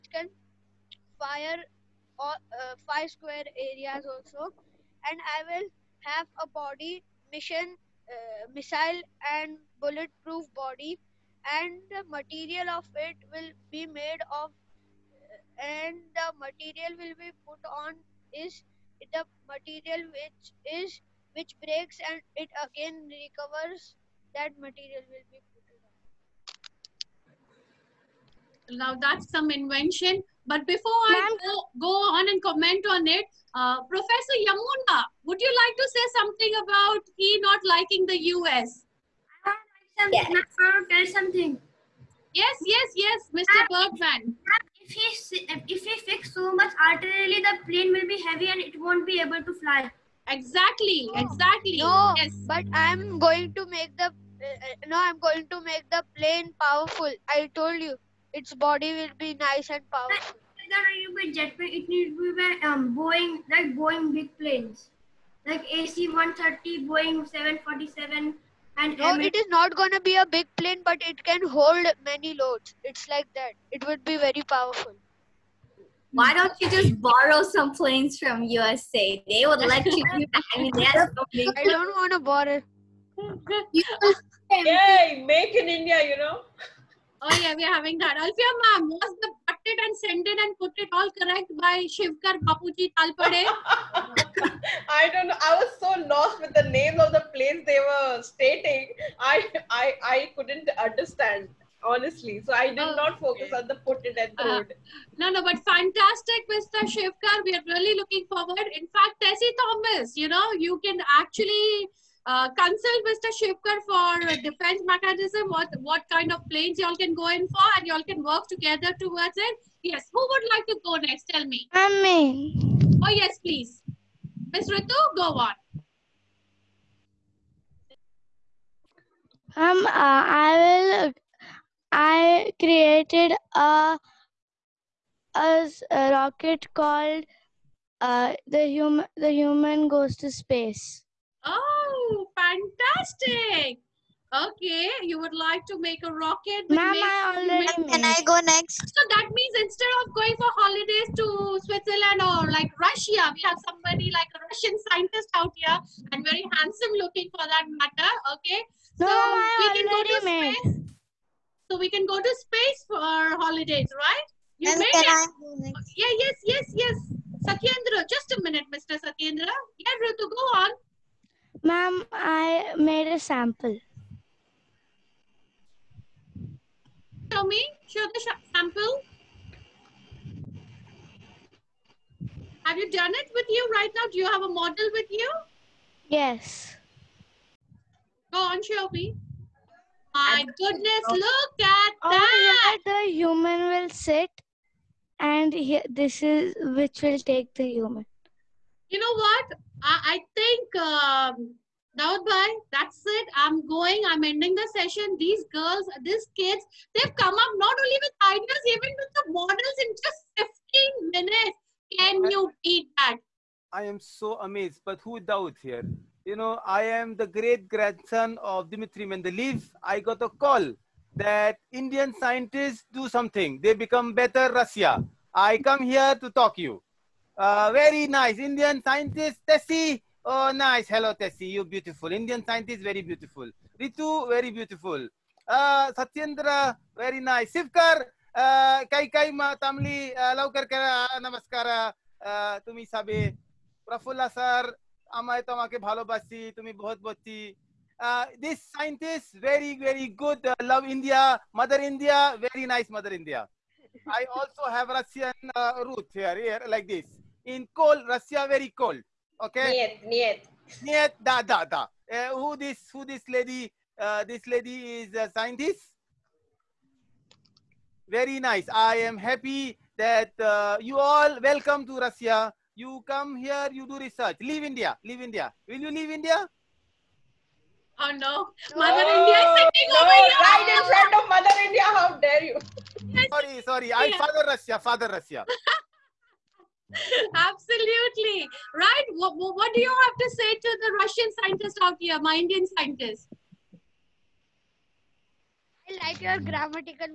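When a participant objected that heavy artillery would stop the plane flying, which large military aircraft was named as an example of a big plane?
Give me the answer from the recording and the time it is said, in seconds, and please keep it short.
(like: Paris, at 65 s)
AC 130, at 65 s.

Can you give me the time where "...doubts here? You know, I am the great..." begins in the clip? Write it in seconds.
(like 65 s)
215 s.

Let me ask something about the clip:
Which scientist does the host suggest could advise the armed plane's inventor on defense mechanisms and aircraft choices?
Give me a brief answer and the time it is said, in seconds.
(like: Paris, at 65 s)
Tessie Thomas, at 109 s.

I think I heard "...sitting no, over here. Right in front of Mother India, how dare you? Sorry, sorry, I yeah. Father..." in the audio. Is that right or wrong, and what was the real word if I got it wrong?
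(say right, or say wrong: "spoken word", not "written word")
right.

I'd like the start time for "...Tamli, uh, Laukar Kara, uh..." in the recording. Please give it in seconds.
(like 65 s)
239 s.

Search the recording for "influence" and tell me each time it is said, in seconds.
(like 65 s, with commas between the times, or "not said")
not said.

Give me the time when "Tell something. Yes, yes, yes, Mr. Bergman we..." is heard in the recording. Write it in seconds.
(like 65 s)
40 s.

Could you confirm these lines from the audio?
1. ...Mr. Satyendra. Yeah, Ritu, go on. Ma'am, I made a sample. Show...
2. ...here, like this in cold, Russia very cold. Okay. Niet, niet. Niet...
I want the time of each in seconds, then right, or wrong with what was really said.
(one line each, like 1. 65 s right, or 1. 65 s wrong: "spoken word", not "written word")
1. 168 s right
2. 256 s right.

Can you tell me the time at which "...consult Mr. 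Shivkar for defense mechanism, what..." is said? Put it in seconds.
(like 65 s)
112 s.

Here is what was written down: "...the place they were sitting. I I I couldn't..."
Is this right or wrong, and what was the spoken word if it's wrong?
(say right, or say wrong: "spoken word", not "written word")
wrong: "stating", not "sitting".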